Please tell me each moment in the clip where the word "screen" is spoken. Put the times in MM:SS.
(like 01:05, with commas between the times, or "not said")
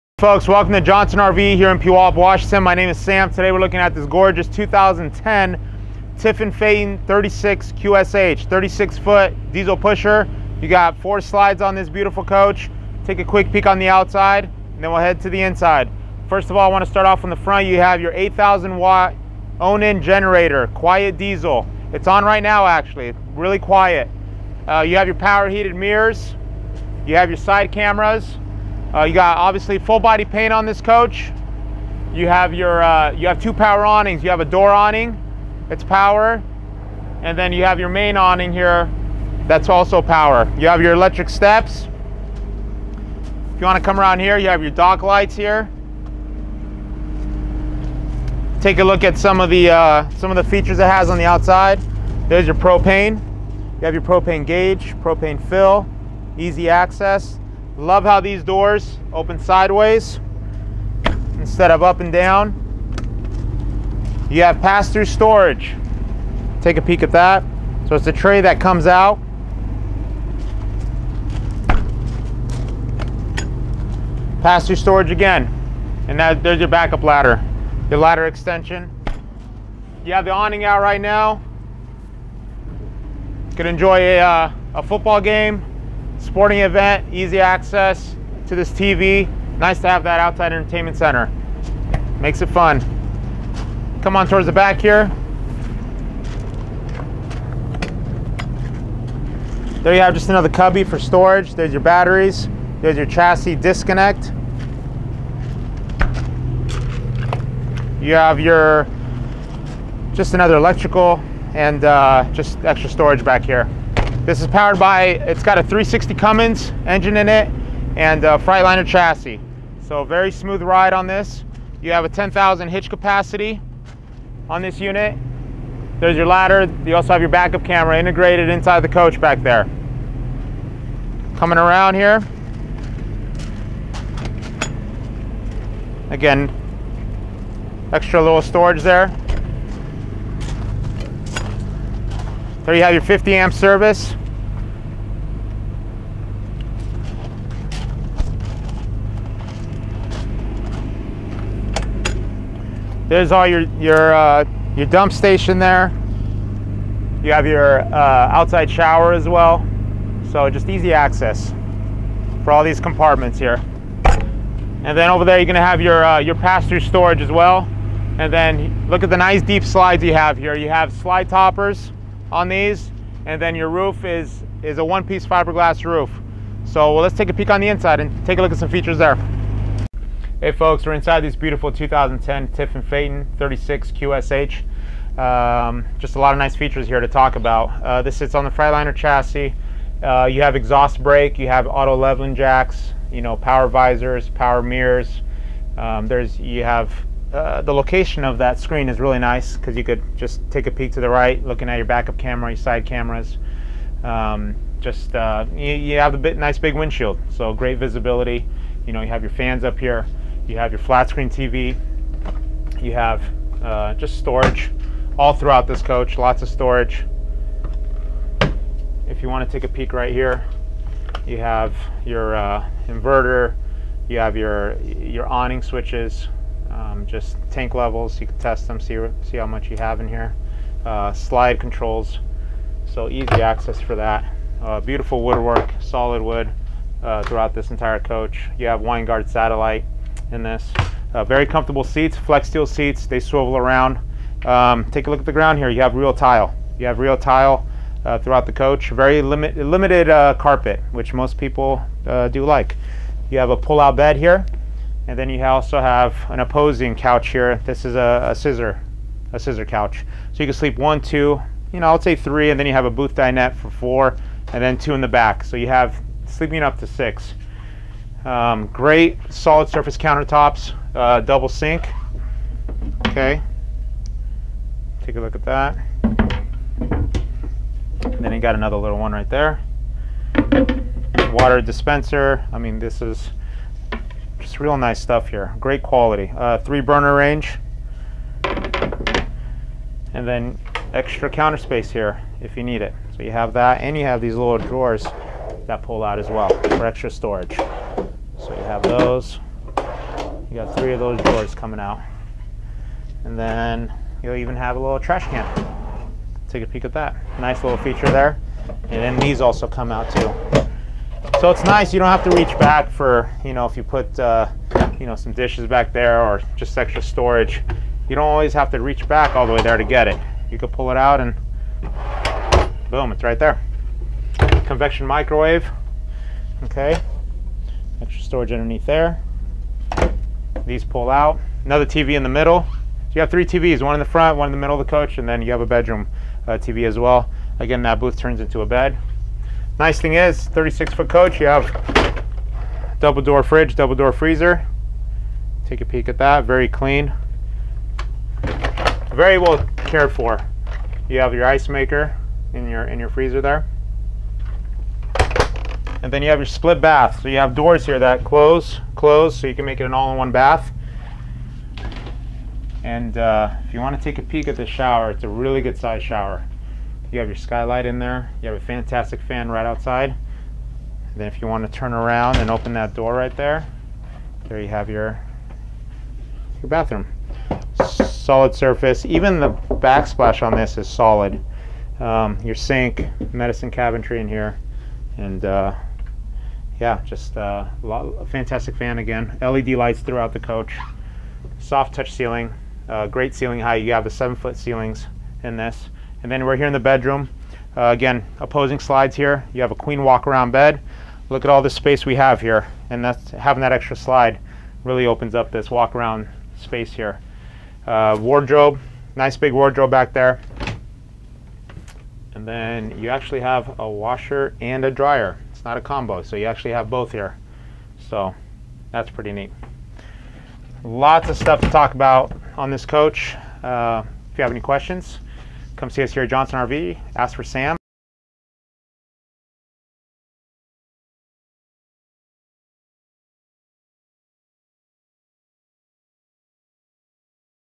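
03:18, 03:31.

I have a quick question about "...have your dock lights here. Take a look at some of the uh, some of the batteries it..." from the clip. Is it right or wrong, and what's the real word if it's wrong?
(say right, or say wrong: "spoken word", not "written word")
wrong: "features", not "batteries".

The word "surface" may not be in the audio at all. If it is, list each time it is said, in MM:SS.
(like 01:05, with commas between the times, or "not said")
04:29, 06:18.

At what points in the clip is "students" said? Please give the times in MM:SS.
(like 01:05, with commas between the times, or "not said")
not said.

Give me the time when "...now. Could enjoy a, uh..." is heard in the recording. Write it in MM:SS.
01:21.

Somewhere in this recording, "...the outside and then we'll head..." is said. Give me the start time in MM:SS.
00:13.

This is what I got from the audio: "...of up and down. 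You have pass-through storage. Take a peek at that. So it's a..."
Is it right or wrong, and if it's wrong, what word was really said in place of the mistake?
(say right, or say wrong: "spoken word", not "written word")
right.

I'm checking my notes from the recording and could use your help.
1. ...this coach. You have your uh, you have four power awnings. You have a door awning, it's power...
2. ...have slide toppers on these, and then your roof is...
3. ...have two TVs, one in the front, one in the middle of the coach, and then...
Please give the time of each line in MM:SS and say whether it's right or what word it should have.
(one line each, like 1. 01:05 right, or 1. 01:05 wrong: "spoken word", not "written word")
1. 00:30 wrong: "two", not "four"
2. 02:50 right
3. 05:33 wrong: "three", not "two".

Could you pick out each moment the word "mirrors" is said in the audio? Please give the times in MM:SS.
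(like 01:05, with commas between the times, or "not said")
00:25, 03:14.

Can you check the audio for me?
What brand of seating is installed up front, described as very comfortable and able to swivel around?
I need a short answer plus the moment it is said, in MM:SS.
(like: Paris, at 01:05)
Flexsteel, at 04:02.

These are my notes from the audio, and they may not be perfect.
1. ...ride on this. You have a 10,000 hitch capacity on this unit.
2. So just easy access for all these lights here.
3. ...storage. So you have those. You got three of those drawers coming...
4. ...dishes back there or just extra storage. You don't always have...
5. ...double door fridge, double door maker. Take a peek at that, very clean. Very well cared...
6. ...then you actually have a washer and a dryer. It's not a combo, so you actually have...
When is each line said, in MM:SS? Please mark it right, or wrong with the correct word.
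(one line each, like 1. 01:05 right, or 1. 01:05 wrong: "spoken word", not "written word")
1. 02:00 right
2. 02:40 wrong: "compartments", not "lights"
3. 04:57 right
4. 05:15 right
5. 05:42 wrong: "freezer", not "maker"
6. 06:52 right.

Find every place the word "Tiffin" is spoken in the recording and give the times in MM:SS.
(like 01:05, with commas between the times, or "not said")
00:06, 03:02.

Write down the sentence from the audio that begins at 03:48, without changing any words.
You can test them, see see how much you have in here.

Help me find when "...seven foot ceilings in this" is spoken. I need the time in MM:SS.
06:34.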